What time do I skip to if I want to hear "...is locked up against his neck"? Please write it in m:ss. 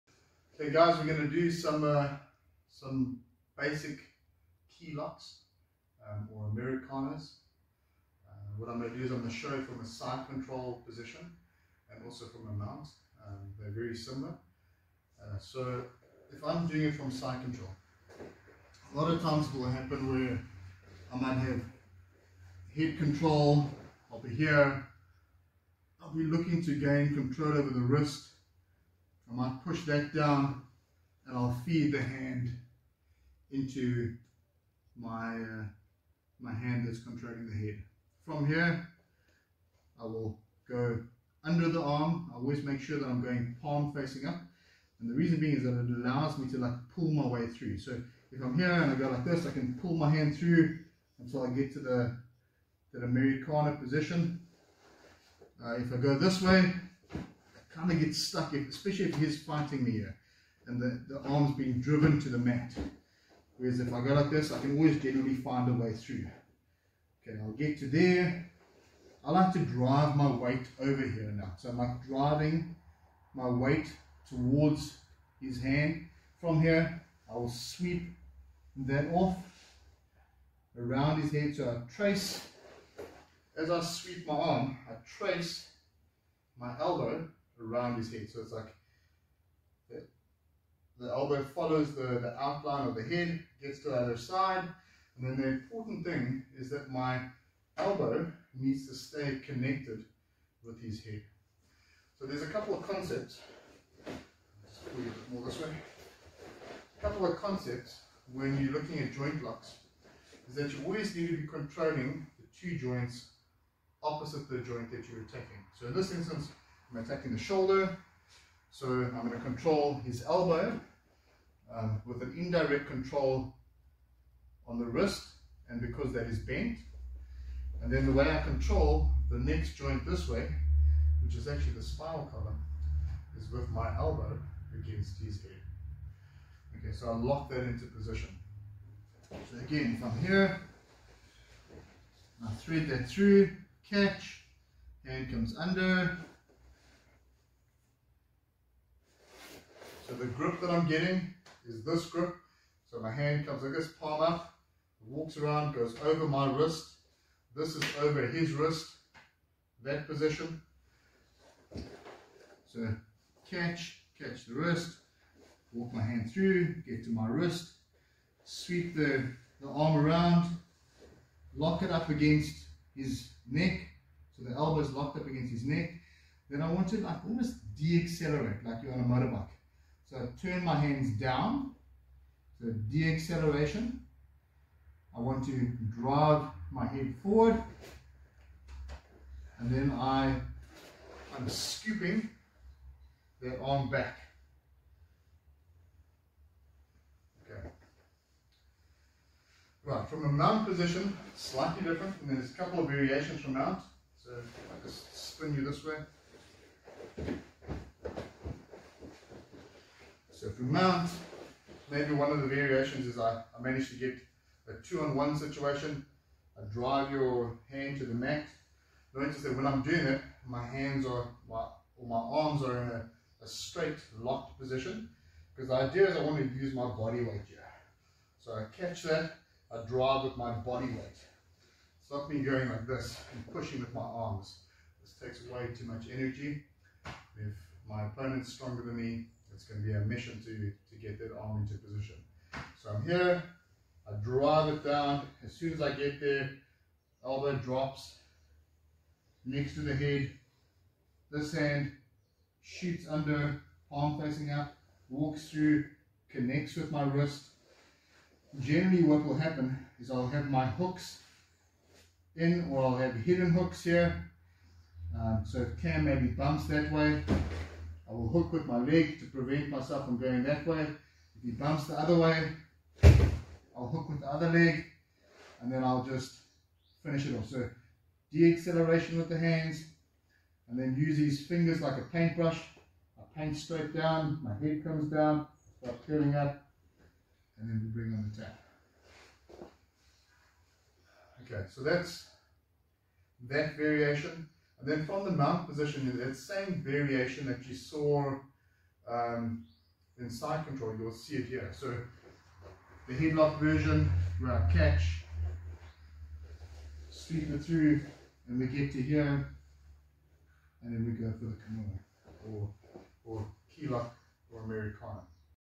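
2:54.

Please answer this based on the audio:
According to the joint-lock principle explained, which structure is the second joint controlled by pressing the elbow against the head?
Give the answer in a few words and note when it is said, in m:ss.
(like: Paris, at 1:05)
The spinal column, at 2:11.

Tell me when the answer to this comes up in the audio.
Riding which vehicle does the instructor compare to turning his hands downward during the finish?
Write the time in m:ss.
2:59.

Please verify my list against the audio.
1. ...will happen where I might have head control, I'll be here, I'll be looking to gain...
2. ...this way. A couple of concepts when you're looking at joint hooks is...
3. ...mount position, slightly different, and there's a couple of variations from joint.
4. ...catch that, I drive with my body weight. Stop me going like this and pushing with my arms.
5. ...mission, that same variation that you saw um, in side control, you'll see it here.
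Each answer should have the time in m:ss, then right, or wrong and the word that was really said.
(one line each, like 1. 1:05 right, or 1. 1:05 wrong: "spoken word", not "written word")
1. 0:19 right
2. 1:45 wrong: "locks", not "hooks"
3. 3:20 wrong: "mount", not "joint"
4. 3:48 right
5. 4:55 wrong: "position", not "mission".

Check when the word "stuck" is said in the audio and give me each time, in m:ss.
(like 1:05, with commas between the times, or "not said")
0:58.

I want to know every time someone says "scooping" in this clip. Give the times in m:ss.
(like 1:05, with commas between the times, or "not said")
3:11.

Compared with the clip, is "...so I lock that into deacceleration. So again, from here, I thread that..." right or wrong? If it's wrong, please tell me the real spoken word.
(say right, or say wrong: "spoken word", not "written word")
wrong: "position", not "deacceleration".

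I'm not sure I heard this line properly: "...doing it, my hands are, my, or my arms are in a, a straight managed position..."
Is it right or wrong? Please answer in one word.
wrong.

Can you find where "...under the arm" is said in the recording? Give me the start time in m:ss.
0:41.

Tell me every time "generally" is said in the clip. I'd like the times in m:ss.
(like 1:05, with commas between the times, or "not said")
1:05, 4:18.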